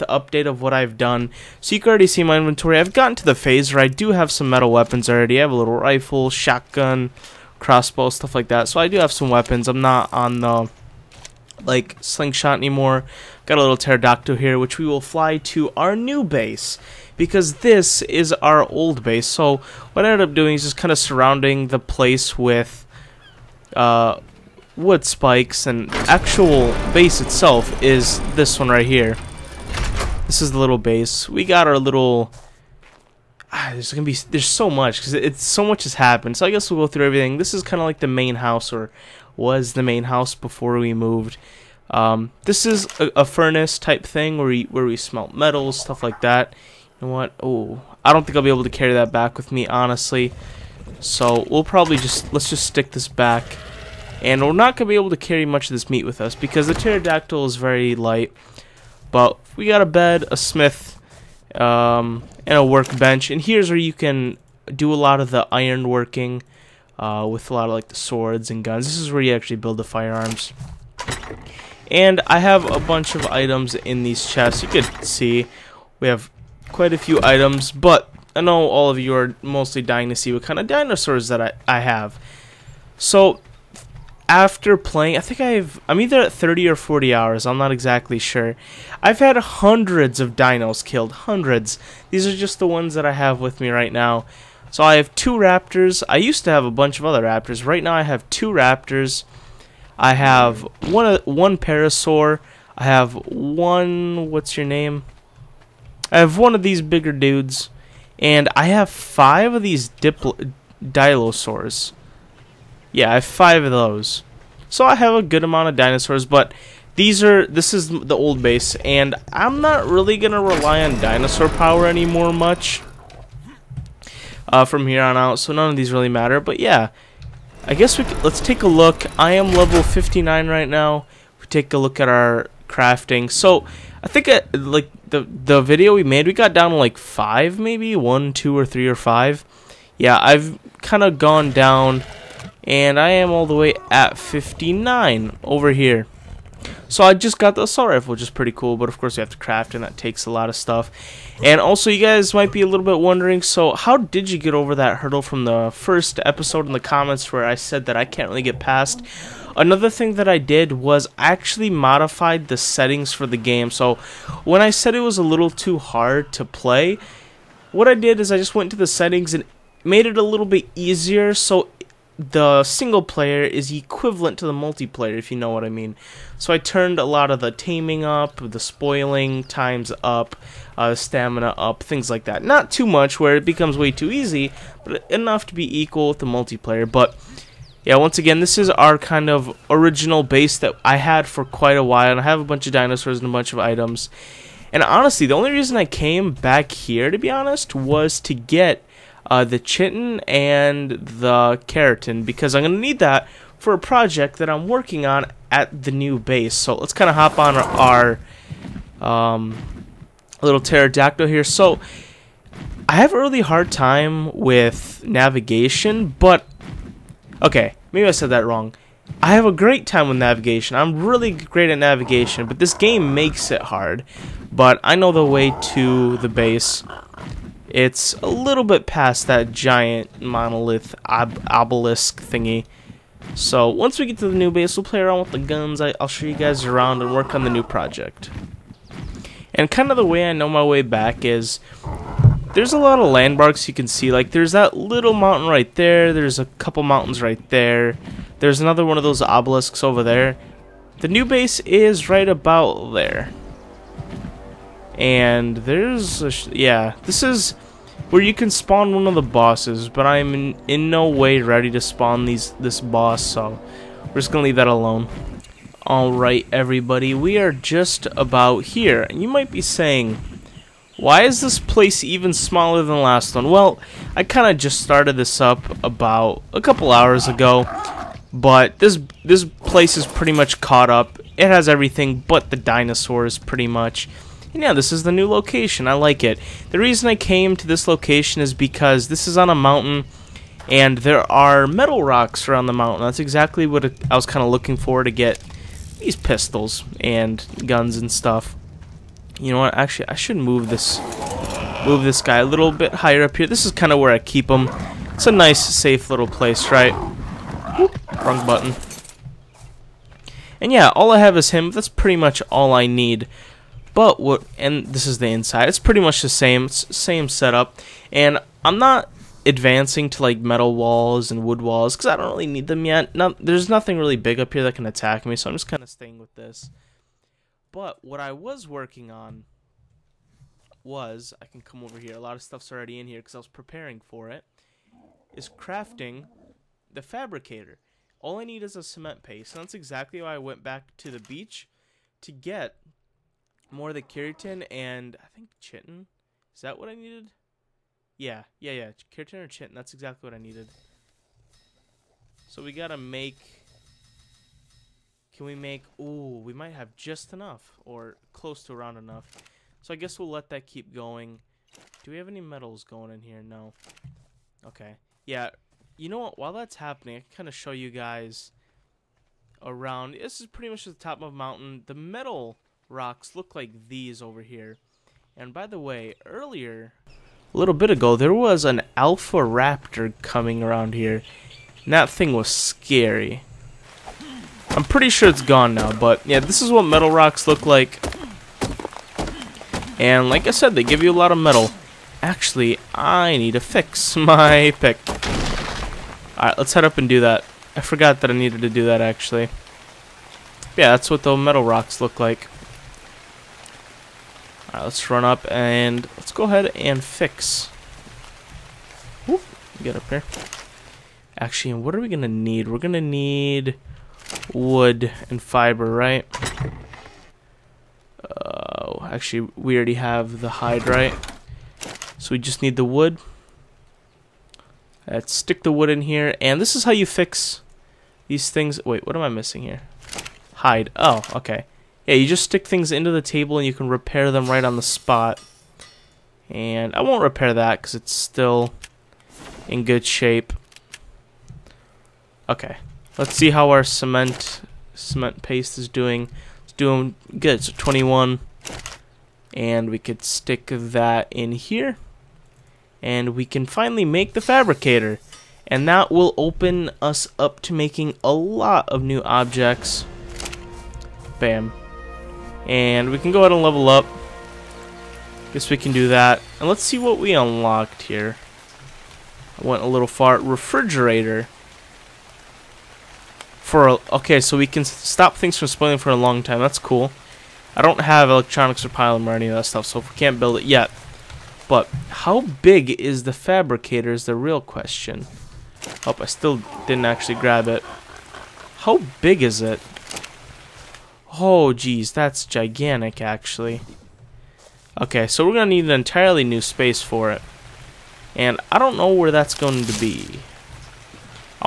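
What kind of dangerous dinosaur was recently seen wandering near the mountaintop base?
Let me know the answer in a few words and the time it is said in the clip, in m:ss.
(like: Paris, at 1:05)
Alpha raptor, at 6:18.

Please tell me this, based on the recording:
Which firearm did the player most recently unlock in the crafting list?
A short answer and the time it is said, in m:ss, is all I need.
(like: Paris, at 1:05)
Assault rifle, at 2:27.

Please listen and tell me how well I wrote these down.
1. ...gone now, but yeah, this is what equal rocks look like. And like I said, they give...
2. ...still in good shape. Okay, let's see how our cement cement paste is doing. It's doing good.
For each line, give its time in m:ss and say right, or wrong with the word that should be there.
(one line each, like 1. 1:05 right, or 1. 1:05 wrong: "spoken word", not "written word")
1. 6:25 wrong: "metal", not "equal"
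2. 7:18 right.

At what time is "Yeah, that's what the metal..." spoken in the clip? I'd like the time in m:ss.
6:40.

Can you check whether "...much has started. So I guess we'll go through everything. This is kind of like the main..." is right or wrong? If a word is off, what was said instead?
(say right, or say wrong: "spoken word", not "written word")
wrong: "happened", not "started".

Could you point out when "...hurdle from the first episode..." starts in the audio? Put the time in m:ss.
2:34.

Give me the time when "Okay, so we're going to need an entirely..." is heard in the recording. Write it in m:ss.
8:15.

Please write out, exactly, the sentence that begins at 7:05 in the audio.
Let's stick the wood in here.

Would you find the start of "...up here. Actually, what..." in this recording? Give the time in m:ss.
6:49.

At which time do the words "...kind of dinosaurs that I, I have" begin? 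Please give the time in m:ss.
1:20.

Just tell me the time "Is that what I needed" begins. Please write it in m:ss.
5:46.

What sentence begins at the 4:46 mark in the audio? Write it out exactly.
The reason I came to this location is because this is on a mountain and there are metal rocks around the mountain.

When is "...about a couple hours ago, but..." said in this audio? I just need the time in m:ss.
4:35.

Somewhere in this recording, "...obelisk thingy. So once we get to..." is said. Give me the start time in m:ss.
3:51.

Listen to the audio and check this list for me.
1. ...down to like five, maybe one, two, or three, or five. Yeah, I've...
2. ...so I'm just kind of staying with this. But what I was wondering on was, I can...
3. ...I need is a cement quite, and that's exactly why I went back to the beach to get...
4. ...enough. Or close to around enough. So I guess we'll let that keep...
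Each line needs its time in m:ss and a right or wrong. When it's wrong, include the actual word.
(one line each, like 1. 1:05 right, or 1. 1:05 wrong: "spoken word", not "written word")
1. 2:16 right
2. 5:25 wrong: "working", not "wondering"
3. 5:38 wrong: "paste", not "quite"
4. 5:57 right.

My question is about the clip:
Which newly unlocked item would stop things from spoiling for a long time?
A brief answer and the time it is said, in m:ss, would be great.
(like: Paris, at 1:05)
Refrigerator, at 7:50.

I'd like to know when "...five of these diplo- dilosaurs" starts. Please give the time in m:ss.
1:48.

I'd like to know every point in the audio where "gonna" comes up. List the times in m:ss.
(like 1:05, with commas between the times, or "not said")
0:33, 2:00, 4:24.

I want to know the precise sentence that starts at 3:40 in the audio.
I'm really great at navigation, but this game makes it hard.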